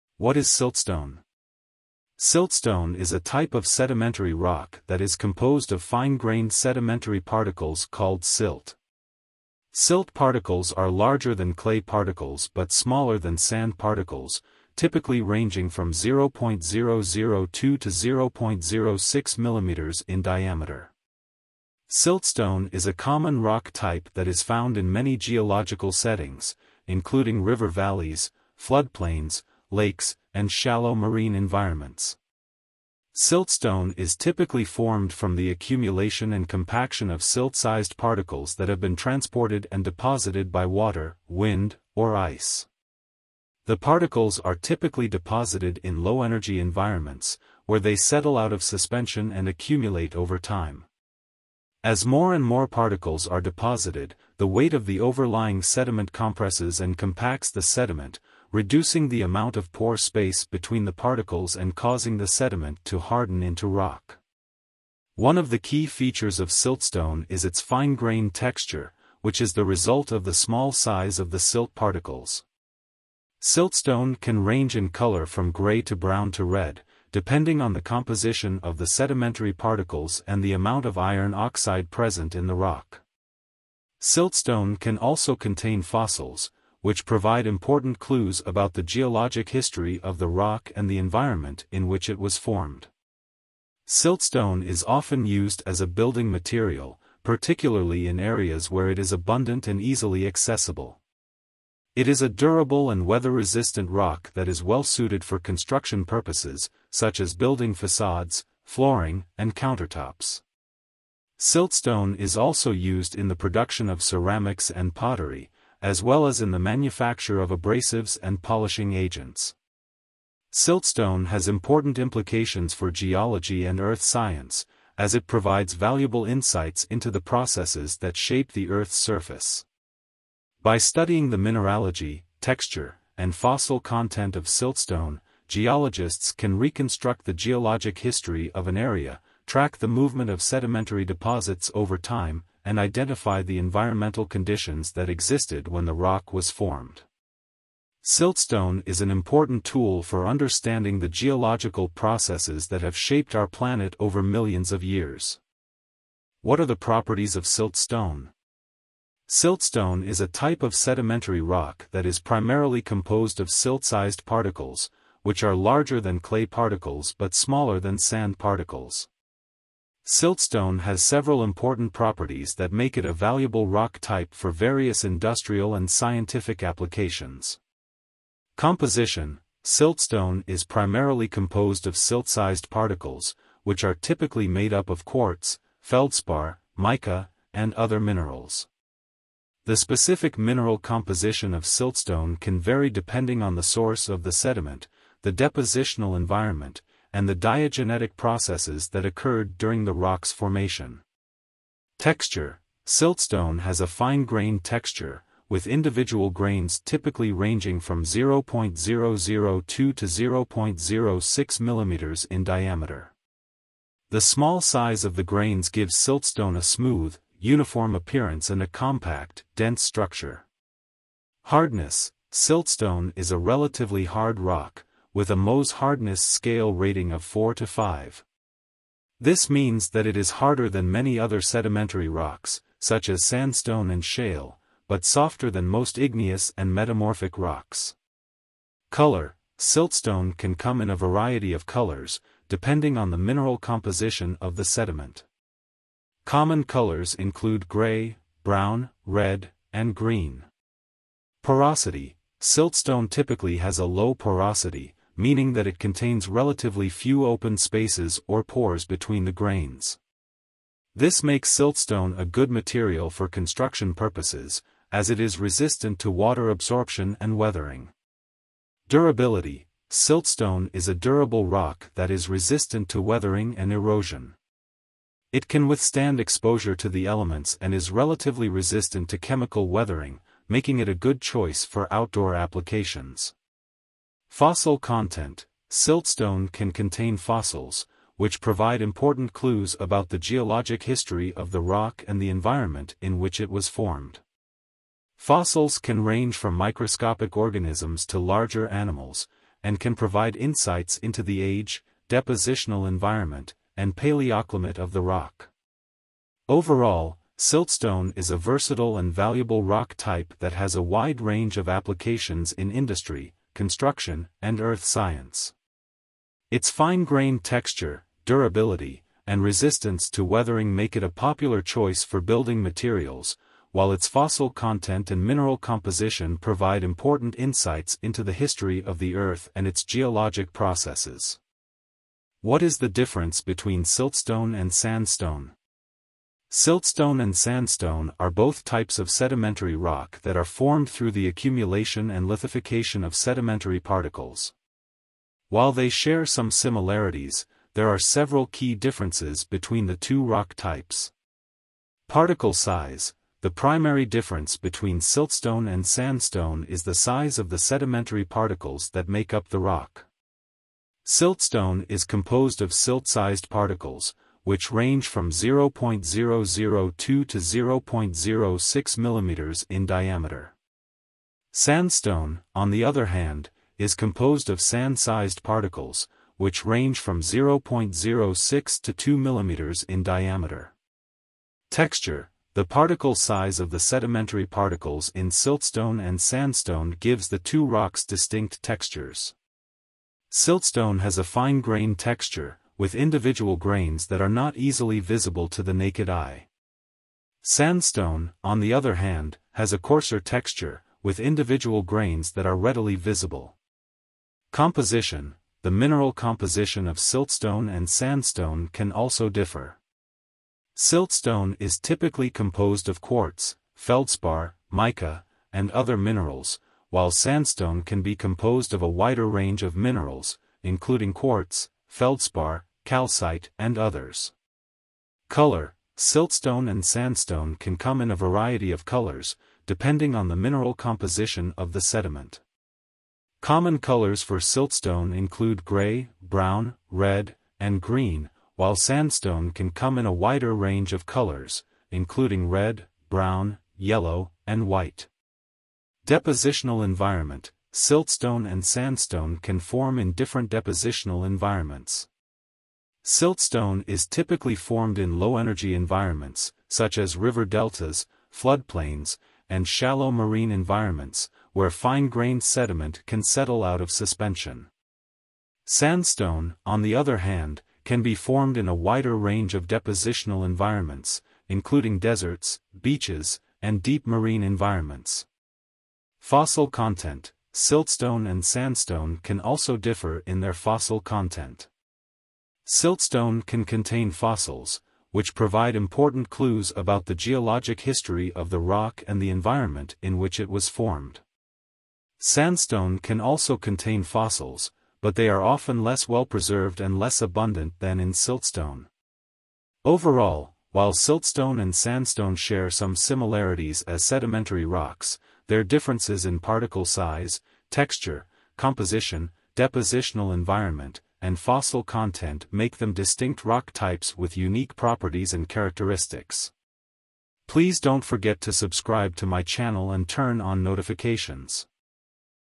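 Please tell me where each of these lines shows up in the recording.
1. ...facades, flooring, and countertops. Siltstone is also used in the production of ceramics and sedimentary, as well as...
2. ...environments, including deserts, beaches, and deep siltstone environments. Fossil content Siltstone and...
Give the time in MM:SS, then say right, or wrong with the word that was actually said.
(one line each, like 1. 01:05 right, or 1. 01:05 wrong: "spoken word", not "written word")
1. 01:47 wrong: "pottery", not "sedimentary"
2. 07:50 wrong: "marine", not "siltstone".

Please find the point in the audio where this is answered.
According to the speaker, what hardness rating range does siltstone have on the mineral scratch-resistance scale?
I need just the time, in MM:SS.
03:47.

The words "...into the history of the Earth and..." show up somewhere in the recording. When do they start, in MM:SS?
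05:28.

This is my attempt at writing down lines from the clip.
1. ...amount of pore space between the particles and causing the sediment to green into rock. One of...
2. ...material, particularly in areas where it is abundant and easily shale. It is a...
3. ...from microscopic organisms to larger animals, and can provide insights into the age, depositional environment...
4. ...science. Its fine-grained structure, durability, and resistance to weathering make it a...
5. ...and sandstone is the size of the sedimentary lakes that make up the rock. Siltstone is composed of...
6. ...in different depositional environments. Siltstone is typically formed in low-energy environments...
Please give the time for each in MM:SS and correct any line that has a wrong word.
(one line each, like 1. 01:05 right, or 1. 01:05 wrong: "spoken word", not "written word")
1. 00:59 wrong: "harden", not "green"
2. 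01:36 wrong: "accessible", not "shale"
3. 04:56 right
4. 05:14 wrong: "texture", not "structure"
5. 05:55 wrong: "particles", not "lakes"
6. 07:29 right.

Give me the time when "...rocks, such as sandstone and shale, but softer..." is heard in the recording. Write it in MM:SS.
03:52.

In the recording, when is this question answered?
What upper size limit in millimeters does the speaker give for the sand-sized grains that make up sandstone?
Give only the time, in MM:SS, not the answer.
06:18.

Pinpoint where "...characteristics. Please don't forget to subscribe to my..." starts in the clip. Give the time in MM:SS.
08:35.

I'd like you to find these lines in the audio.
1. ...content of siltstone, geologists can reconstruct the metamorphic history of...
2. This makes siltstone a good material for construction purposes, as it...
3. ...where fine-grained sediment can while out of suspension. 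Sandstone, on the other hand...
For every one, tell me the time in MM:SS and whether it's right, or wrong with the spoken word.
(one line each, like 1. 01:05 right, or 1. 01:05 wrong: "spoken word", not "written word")
1. 02:13 wrong: "geologic", not "metamorphic"
2. 04:20 right
3. 07:41 wrong: "settle", not "while".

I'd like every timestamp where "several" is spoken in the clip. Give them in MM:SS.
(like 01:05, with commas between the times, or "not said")
02:51, 05:47.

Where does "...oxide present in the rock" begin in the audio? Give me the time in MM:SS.
01:21.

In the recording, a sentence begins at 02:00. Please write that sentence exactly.
Siltstone has important implications for geology and earth science, as it provides valuable insights into the processes that shape the Earth's surface.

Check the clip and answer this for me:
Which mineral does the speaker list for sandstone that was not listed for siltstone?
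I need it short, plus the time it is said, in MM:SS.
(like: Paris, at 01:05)
calcite, at 07:02.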